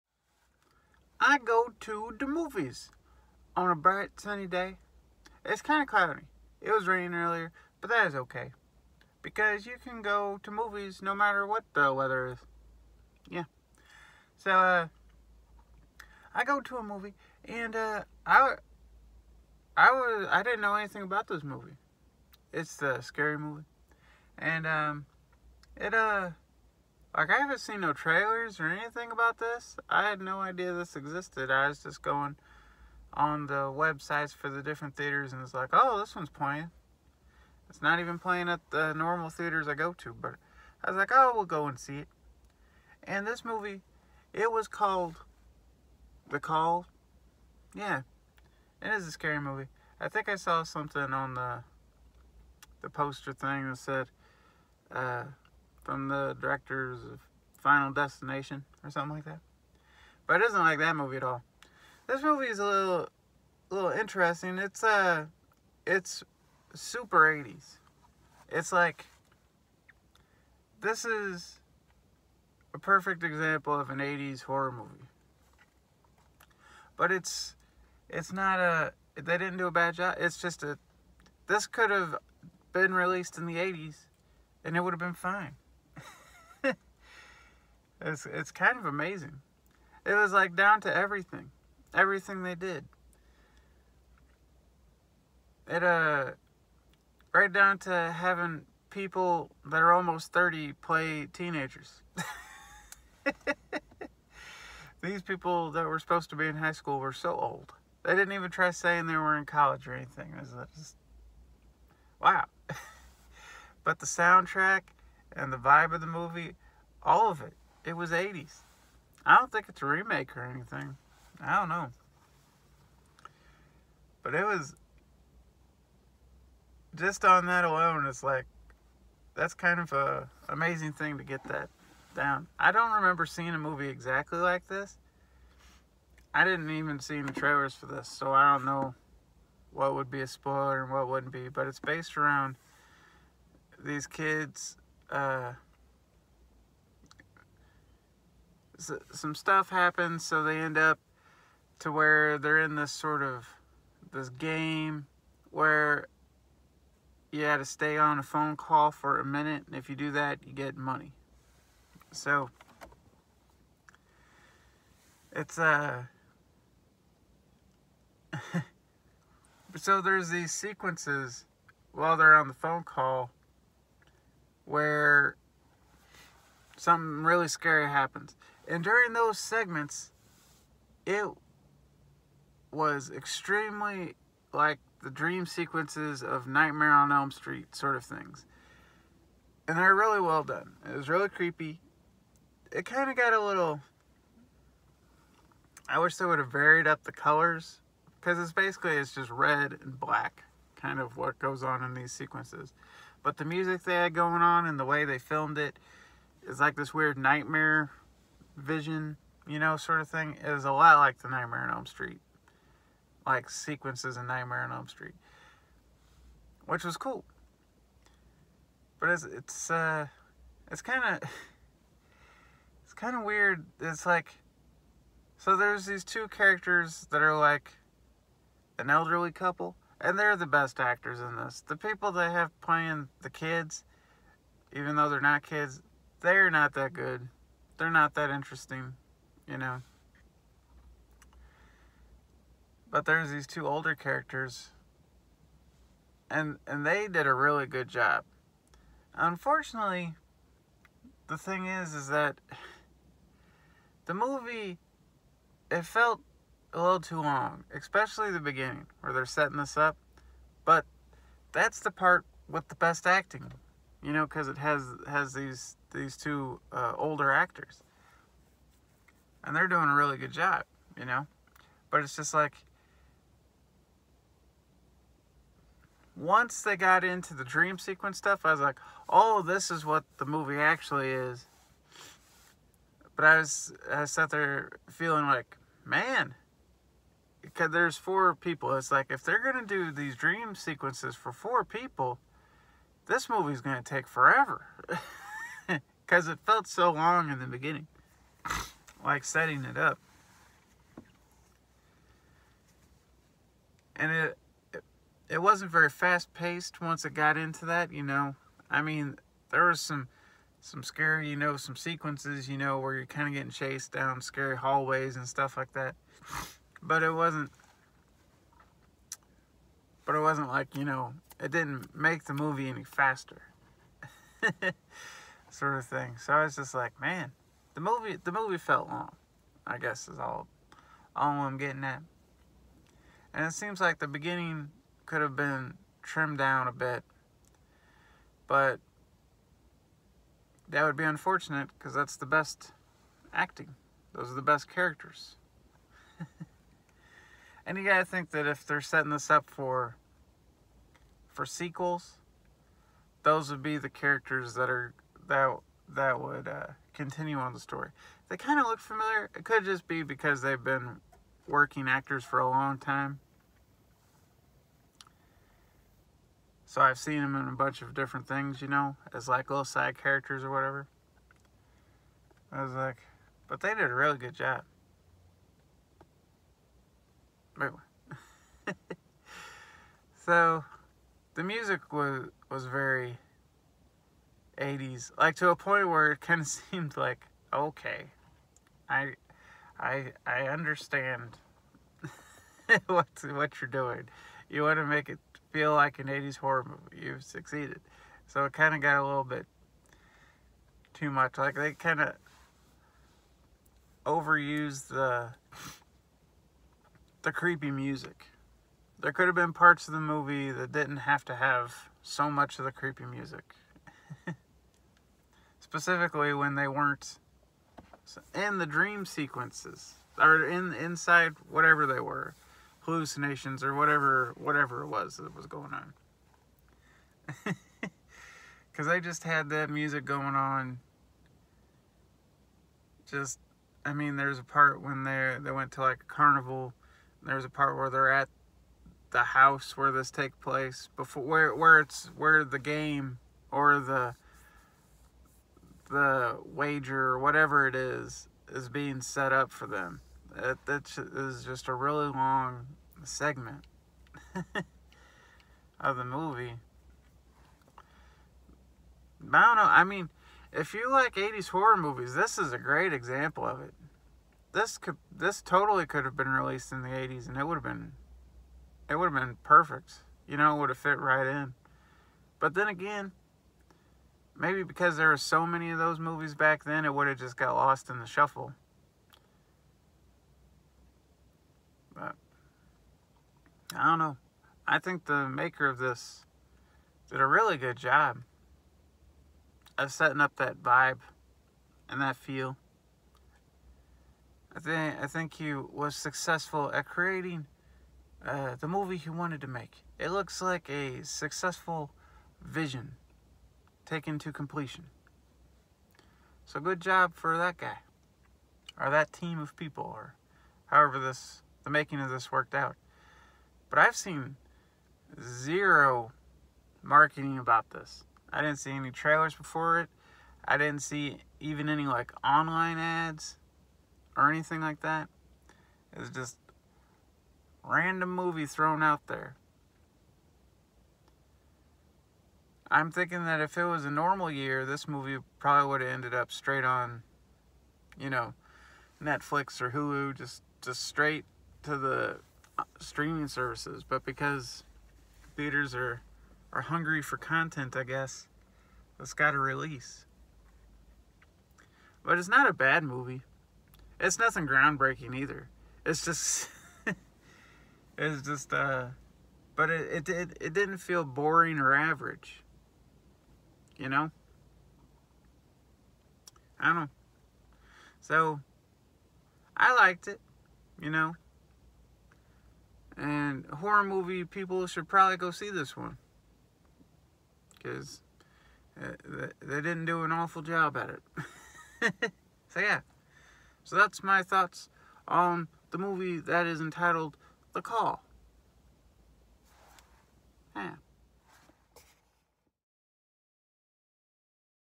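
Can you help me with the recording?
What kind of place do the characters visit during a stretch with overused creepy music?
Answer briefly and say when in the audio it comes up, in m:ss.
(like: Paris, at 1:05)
a carnival, at 7:16.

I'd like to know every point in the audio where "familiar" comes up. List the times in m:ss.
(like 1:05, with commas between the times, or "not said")
5:58.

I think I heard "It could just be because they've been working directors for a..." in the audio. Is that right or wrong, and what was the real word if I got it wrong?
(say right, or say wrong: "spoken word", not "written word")
wrong: "actors", not "directors".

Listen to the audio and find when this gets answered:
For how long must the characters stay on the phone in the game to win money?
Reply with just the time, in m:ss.
2:39.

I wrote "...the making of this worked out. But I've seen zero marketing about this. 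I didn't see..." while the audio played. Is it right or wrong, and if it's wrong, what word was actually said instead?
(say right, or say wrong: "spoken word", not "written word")
right.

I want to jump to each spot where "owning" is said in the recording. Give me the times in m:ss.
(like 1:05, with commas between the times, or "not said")
not said.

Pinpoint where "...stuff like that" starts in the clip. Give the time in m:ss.
5:15.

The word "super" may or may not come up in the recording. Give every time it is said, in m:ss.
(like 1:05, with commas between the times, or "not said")
1:06.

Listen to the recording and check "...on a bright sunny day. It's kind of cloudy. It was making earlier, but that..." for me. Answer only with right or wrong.
wrong.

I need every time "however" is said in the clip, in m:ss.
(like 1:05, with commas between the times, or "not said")
8:30.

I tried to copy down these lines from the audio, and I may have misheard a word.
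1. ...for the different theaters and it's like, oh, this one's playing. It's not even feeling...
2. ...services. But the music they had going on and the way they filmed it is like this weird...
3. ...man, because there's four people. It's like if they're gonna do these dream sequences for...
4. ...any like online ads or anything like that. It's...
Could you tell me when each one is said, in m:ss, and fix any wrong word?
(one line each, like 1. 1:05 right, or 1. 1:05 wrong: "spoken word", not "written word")
1. 0:34 wrong: "playing", not "feeling"
2. 3:22 wrong: "sequences", not "services"
3. 4:45 right
4. 8:41 right.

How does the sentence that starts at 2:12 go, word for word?
I don't remember seeing a movie exactly like this.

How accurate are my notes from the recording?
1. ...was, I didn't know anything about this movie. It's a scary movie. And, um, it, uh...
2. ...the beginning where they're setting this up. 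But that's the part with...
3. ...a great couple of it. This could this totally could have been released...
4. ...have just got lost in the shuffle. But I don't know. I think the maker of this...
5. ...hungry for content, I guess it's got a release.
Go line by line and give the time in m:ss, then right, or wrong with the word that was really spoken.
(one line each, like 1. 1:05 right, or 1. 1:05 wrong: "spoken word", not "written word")
1. 0:19 right
2. 4:18 right
3. 7:42 wrong: "example", not "couple"
4. 7:57 right
5. 9:06 right.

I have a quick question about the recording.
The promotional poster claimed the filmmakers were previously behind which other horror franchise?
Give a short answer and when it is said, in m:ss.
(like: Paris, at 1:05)
Final Destination, at 0:57.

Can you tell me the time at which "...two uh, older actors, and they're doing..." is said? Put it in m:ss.
4:26.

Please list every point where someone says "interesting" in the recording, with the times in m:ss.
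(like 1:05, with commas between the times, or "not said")
1:03, 3:58.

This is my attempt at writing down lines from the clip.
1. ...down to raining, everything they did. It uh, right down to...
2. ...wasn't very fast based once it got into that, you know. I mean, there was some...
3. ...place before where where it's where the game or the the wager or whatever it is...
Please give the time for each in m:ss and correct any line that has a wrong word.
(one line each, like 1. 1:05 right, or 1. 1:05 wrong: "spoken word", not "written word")
1. 1:30 wrong: "everything", not "raining"
2. 5:05 wrong: "paced", not "based"
3. 7:20 right.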